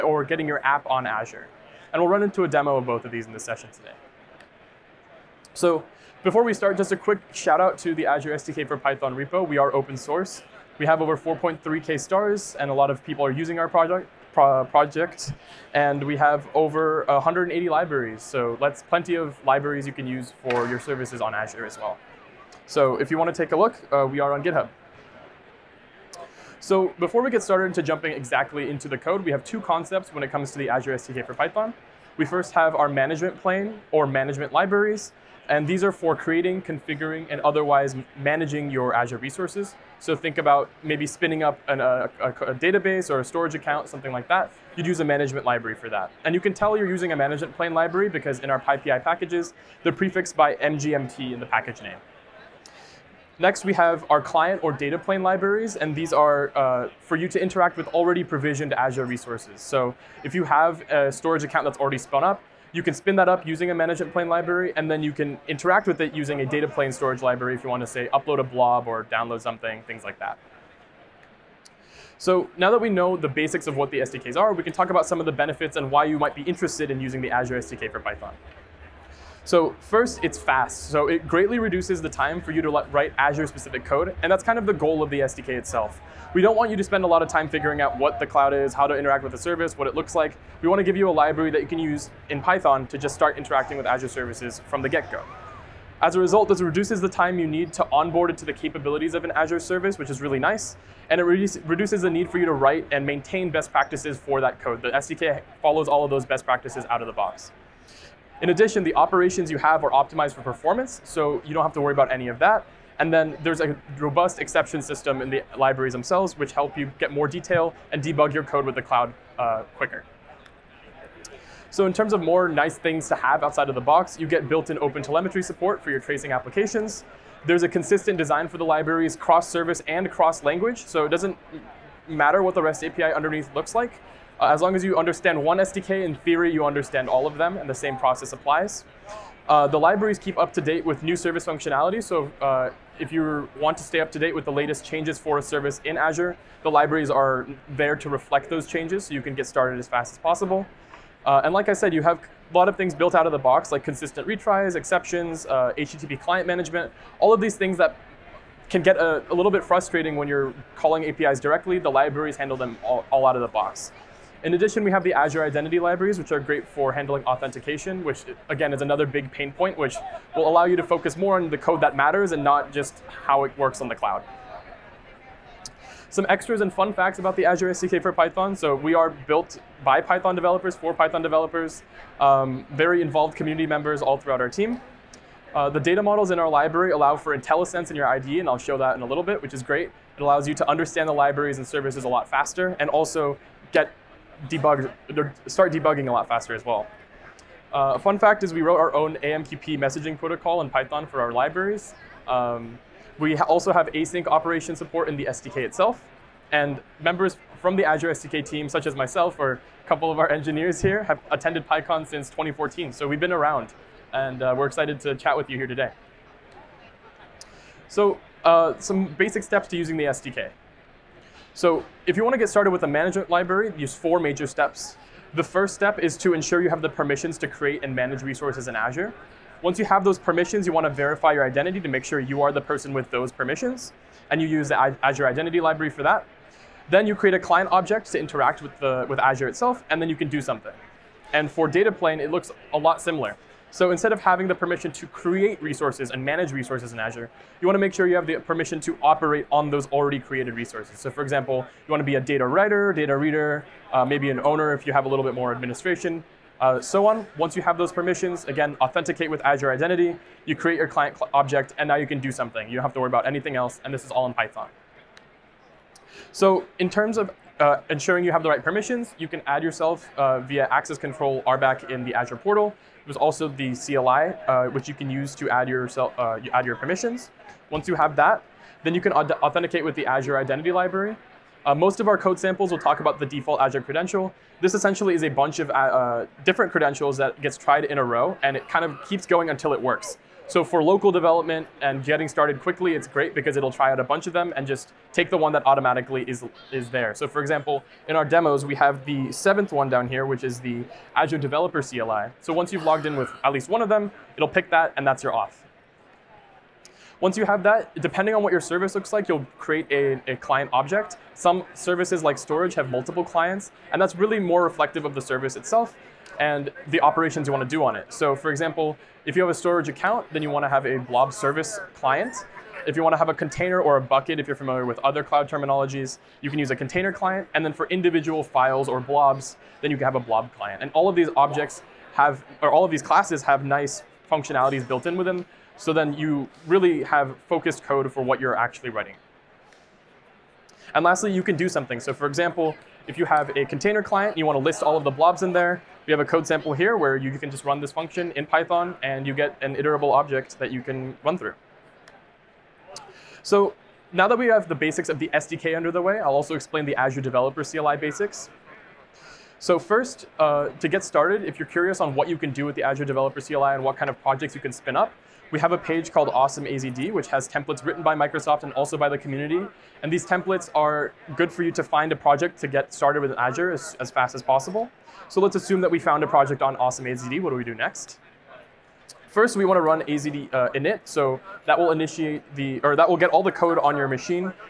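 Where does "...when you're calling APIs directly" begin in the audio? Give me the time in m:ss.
2:40.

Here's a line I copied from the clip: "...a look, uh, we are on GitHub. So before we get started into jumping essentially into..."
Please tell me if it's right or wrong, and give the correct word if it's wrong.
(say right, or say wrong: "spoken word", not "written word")
wrong: "exactly", not "essentially".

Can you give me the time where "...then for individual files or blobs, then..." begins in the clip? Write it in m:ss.
5:27.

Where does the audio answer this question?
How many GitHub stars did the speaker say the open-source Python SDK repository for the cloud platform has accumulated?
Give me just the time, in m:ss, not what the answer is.
0:11.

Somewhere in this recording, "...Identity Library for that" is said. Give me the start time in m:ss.
3:55.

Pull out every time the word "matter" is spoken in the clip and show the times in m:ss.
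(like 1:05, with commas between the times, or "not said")
2:12, 2:51.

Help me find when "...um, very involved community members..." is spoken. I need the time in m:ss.
3:02.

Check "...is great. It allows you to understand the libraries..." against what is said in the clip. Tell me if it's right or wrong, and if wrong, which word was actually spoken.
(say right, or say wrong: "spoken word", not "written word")
right.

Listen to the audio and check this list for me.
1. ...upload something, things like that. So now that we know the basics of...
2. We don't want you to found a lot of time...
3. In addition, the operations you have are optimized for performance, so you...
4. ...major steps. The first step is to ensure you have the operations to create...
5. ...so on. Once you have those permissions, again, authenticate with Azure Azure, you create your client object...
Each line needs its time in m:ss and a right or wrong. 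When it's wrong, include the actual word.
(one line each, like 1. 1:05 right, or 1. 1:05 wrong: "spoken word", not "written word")
1. 1:09 wrong: "download", not "upload"
2. 1:26 wrong: "spend", not "found"
3. 1:48 right
4. 3:44 wrong: "permissions", not "operations"
5. 4:16 wrong: "Identity", not "Azure".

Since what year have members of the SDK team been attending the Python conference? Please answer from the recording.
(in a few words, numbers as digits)
2014.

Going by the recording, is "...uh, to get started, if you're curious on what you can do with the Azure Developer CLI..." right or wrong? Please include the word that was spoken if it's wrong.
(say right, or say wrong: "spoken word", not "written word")
right.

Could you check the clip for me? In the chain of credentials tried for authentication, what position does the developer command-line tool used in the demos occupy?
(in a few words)
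seventh.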